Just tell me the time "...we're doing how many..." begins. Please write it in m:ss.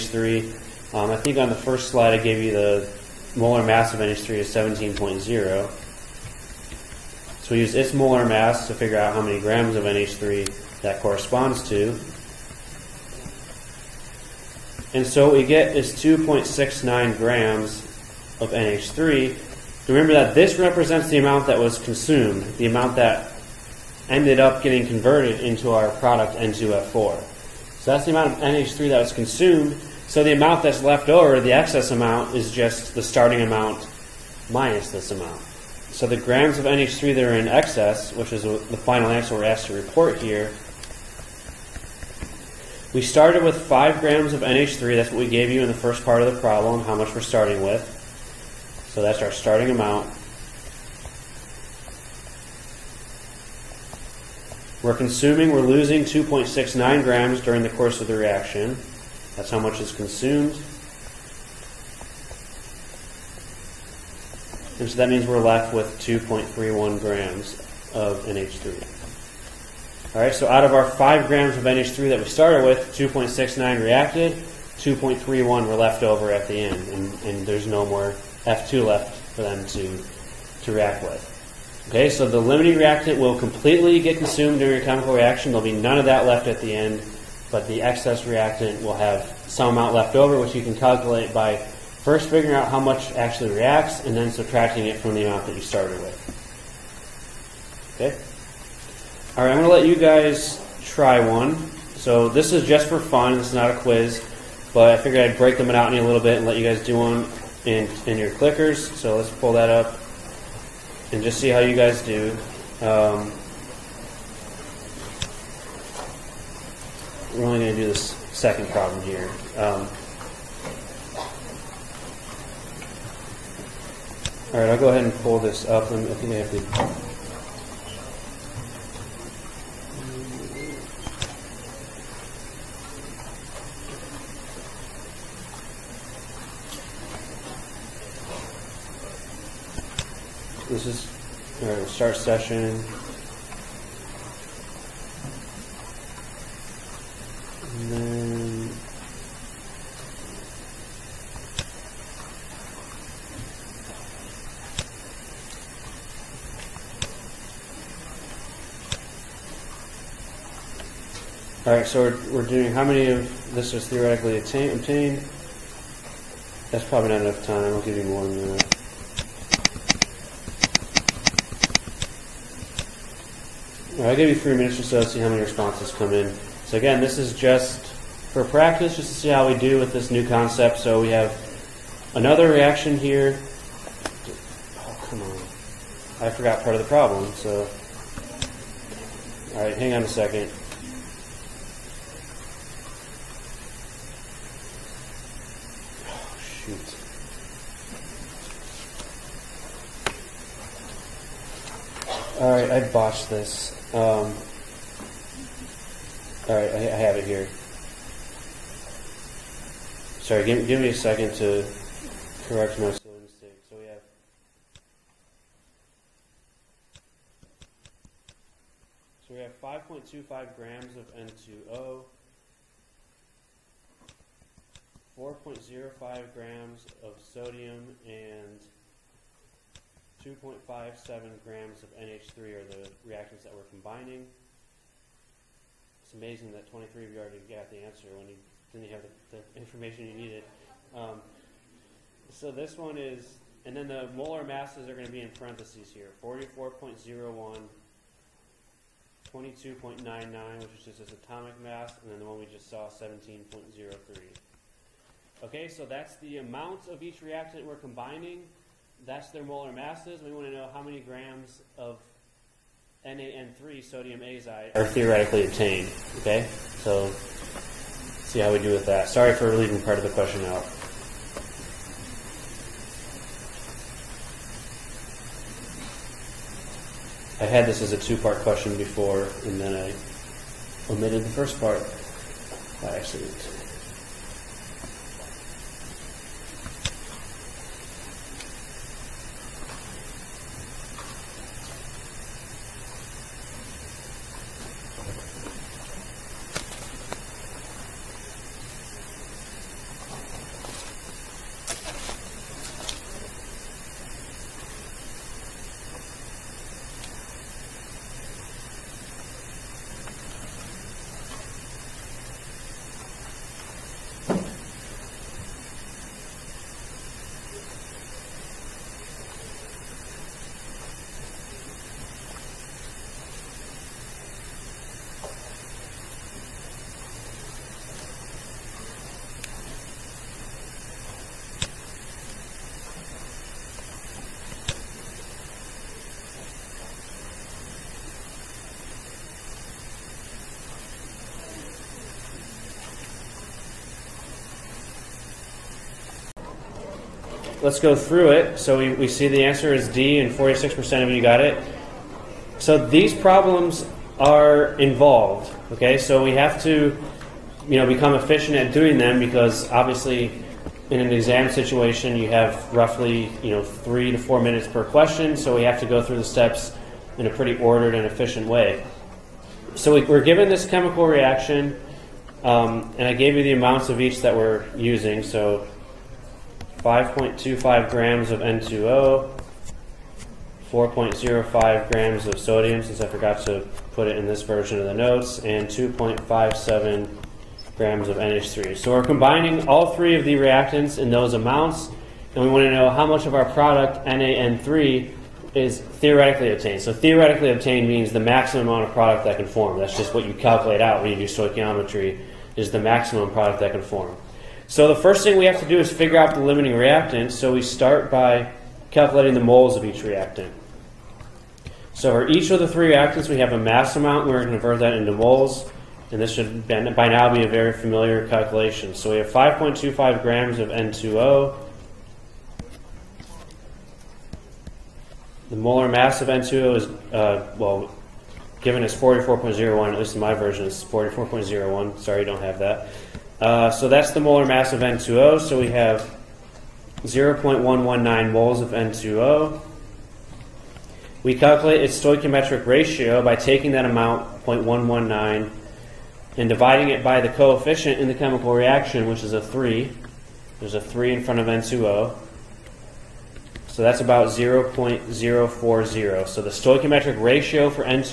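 2:42.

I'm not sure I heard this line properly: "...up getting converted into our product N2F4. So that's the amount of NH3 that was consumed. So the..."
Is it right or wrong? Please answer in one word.
right.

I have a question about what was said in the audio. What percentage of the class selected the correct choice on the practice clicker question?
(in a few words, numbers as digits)
46%.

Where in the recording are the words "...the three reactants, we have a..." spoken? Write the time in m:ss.
6:52.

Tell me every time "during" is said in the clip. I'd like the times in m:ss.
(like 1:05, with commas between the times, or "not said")
0:57, 1:24.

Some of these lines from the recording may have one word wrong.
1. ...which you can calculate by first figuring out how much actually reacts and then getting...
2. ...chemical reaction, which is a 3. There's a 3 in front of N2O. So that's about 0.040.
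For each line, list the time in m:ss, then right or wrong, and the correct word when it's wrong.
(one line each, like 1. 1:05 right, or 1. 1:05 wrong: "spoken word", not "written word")
1. 1:30 wrong: "subtracting", not "getting"
2. 7:28 right.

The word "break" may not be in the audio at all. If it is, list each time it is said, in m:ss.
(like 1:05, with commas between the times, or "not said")
1:45.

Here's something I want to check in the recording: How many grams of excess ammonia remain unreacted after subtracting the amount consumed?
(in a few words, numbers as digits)
2.31 grams.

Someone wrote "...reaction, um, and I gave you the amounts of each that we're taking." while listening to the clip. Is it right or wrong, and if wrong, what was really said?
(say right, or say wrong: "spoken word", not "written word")
wrong: "using", not "taking".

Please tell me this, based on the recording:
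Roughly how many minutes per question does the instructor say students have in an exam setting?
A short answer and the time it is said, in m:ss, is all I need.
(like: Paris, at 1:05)
3 to 4 minutes, at 6:03.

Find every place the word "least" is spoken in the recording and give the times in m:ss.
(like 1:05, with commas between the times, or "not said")
7:09.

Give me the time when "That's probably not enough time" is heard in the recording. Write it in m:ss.
2:46.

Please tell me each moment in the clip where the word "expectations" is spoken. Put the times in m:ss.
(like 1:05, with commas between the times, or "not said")
not said.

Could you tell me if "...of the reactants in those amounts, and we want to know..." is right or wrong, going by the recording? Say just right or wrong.
right.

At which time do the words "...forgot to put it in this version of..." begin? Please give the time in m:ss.
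6:23.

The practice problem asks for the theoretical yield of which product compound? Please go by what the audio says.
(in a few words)
sodium azide.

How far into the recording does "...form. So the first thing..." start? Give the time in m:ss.
6:43.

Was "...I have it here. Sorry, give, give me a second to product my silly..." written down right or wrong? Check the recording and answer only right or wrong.
wrong.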